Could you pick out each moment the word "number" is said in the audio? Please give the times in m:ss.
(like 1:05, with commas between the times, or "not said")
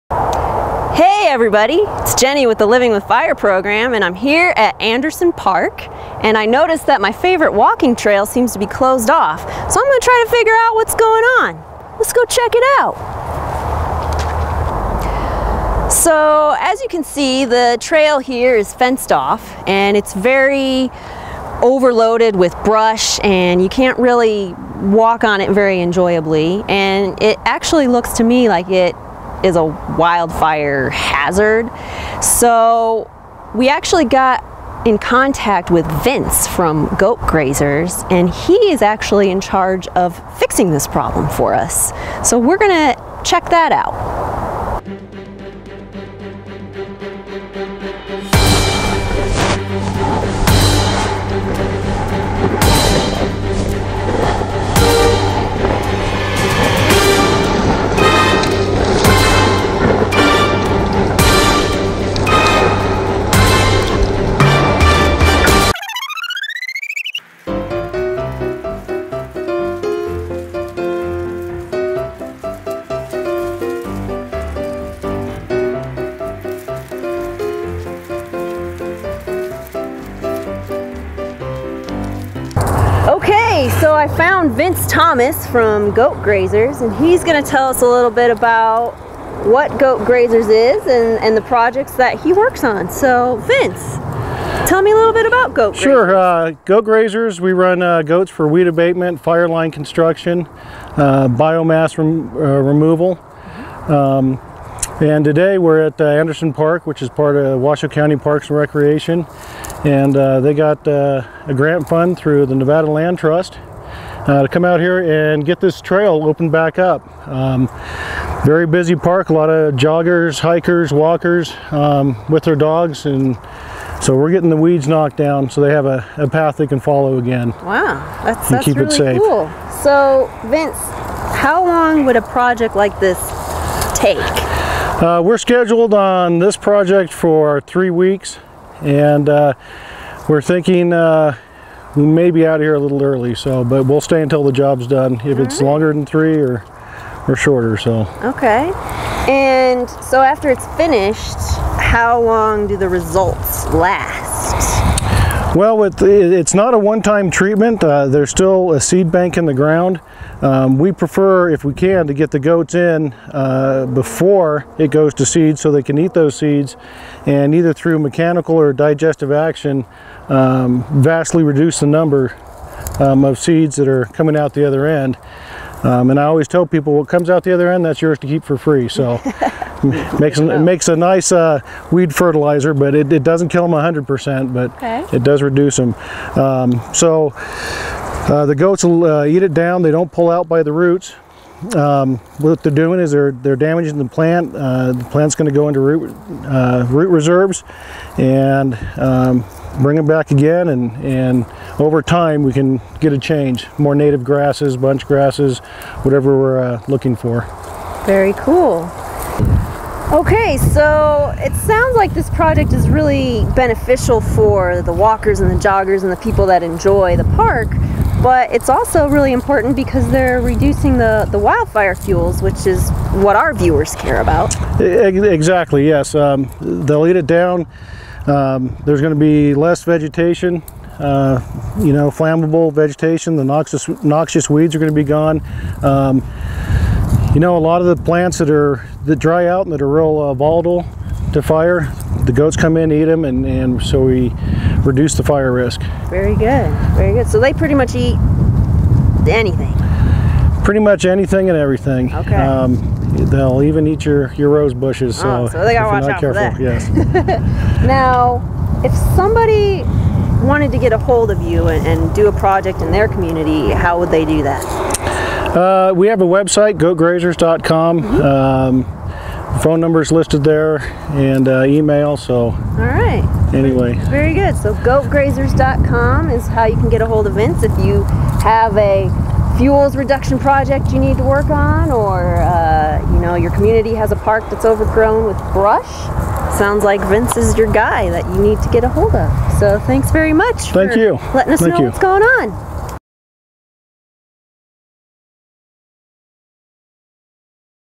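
2:51, 4:29.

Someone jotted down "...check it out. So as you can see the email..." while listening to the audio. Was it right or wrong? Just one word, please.
wrong.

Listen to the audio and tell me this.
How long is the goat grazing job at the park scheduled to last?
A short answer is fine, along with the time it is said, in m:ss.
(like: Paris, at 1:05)
3 weeks, at 2:17.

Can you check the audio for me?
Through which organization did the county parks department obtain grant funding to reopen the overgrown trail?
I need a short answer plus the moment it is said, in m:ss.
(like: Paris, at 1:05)
Nevada Land Trust, at 1:52.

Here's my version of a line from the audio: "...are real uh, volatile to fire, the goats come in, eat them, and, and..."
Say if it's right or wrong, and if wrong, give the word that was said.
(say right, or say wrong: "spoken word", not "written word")
right.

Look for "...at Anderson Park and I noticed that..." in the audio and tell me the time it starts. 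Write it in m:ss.
0:04.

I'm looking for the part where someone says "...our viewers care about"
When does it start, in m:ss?
3:43.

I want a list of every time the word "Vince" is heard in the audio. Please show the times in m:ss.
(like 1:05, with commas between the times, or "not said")
0:36, 1:24, 1:33, 2:10, 4:37, 4:47.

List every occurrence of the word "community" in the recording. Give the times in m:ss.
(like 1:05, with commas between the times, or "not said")
4:23, 4:43.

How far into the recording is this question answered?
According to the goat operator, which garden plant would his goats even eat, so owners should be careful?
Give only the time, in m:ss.
4:14.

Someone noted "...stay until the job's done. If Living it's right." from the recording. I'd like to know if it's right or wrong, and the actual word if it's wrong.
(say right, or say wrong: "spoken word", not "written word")
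wrong: "All", not "Living".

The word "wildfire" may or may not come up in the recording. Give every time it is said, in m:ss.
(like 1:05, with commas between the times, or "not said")
0:29, 3:41.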